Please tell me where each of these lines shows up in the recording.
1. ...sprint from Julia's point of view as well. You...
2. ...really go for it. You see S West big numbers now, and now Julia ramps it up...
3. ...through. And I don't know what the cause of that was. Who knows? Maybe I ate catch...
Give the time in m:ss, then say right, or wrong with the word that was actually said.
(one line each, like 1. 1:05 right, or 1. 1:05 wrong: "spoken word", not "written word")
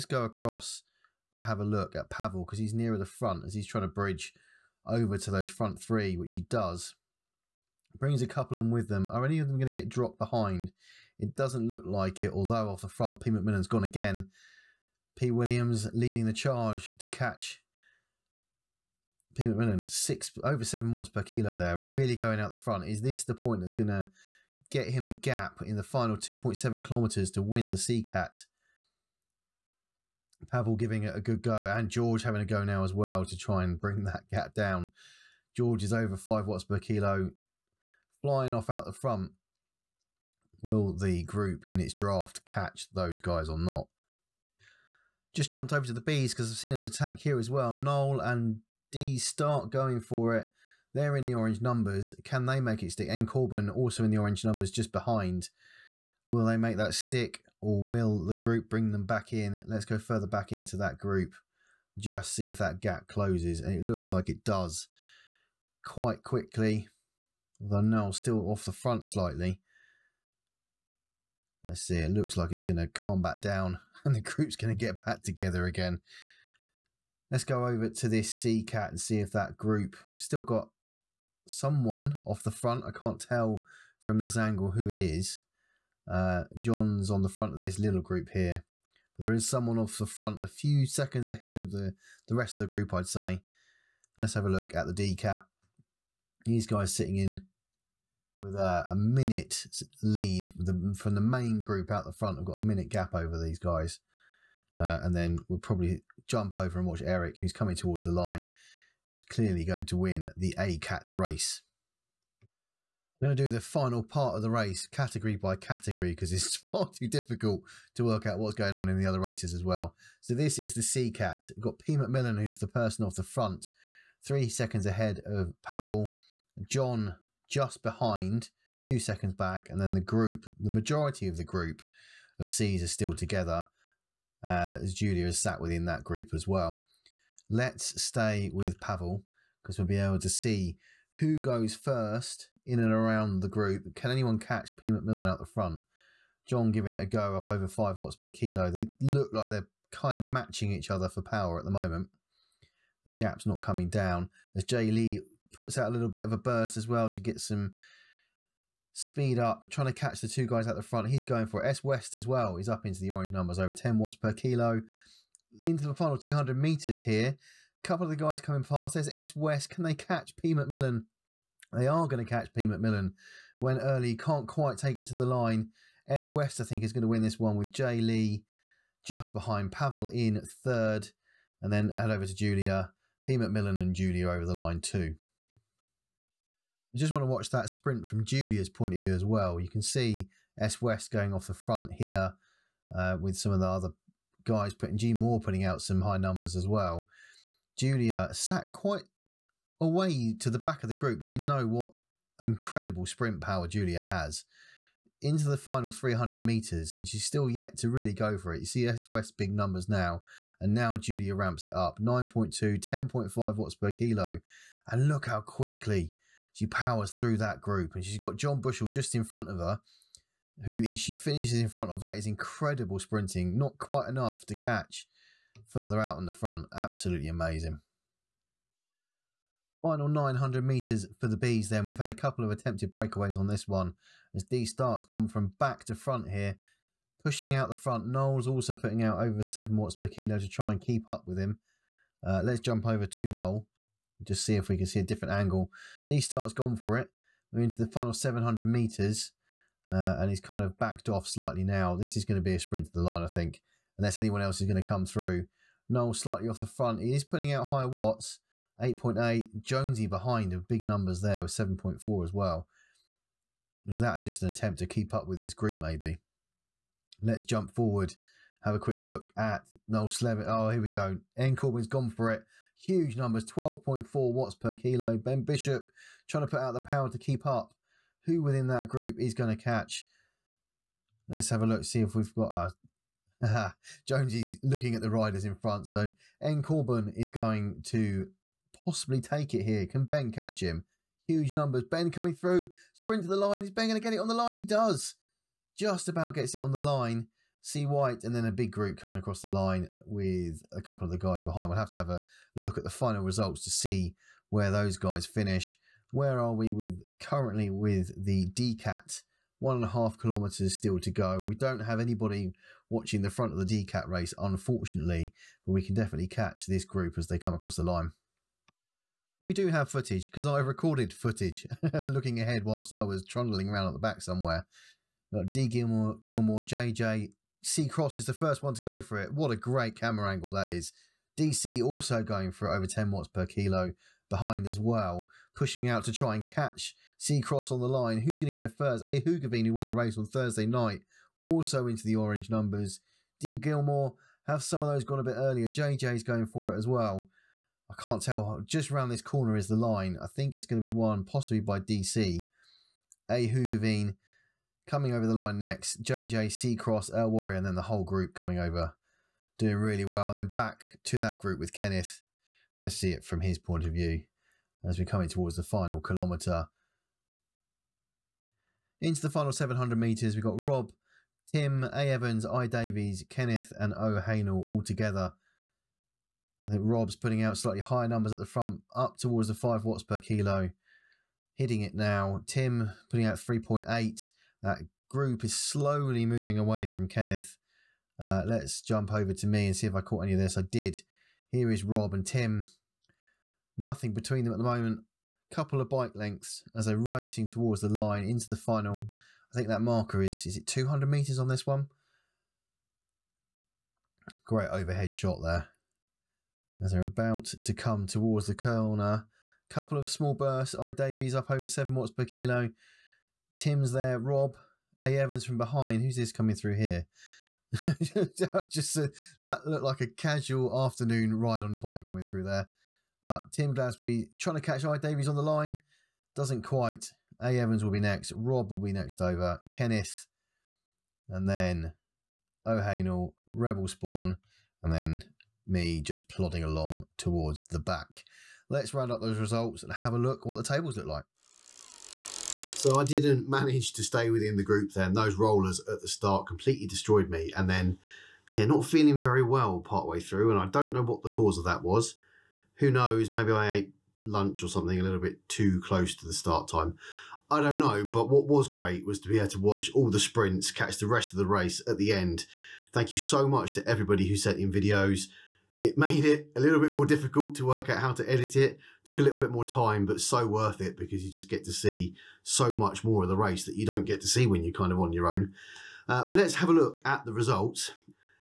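1. 3:07 right
2. 3:27 right
3. 7:30 wrong: "lunch", not "catch".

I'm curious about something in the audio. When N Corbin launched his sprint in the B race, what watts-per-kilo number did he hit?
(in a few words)
12.4.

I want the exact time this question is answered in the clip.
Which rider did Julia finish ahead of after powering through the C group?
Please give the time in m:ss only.
3:38.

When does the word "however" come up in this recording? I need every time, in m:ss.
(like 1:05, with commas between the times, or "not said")
not said.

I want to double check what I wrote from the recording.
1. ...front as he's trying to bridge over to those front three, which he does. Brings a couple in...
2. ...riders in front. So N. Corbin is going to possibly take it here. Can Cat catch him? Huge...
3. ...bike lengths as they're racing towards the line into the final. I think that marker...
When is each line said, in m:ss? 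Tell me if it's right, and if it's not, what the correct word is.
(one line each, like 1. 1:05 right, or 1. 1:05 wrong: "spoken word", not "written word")
1. 0:03 right
2. 4:45 wrong: "Ben", not "Cat"
3. 6:35 right.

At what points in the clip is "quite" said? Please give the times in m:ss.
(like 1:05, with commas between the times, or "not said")
1:05, 2:54, 3:18, 3:43, 7:06.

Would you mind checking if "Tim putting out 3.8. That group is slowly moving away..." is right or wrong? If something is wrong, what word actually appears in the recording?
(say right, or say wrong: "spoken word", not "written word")
right.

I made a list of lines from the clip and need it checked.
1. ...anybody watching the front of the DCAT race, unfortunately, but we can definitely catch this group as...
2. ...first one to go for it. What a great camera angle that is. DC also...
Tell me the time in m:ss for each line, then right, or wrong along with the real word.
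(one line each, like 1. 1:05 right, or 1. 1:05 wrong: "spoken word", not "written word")
1. 5:11 right
2. 5:28 right.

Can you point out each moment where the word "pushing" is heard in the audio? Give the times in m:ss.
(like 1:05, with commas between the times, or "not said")
3:57, 5:35.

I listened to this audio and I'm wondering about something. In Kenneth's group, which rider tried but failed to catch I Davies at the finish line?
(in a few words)
Tim Glasby.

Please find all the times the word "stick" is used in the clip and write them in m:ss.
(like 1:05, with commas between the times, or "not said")
0:52, 0:56.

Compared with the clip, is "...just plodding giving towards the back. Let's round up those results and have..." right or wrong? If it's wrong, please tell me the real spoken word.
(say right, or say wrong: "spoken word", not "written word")
wrong: "along", not "giving".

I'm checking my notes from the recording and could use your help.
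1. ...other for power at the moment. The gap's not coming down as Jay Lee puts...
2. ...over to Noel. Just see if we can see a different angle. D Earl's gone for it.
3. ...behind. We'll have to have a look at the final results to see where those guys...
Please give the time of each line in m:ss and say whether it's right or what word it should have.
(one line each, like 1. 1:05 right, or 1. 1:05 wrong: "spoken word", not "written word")
1. 2:30 right
2. 4:02 wrong: "Stark", not "Earl"
3. 5:01 right.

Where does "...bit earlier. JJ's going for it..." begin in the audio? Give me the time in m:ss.
5:45.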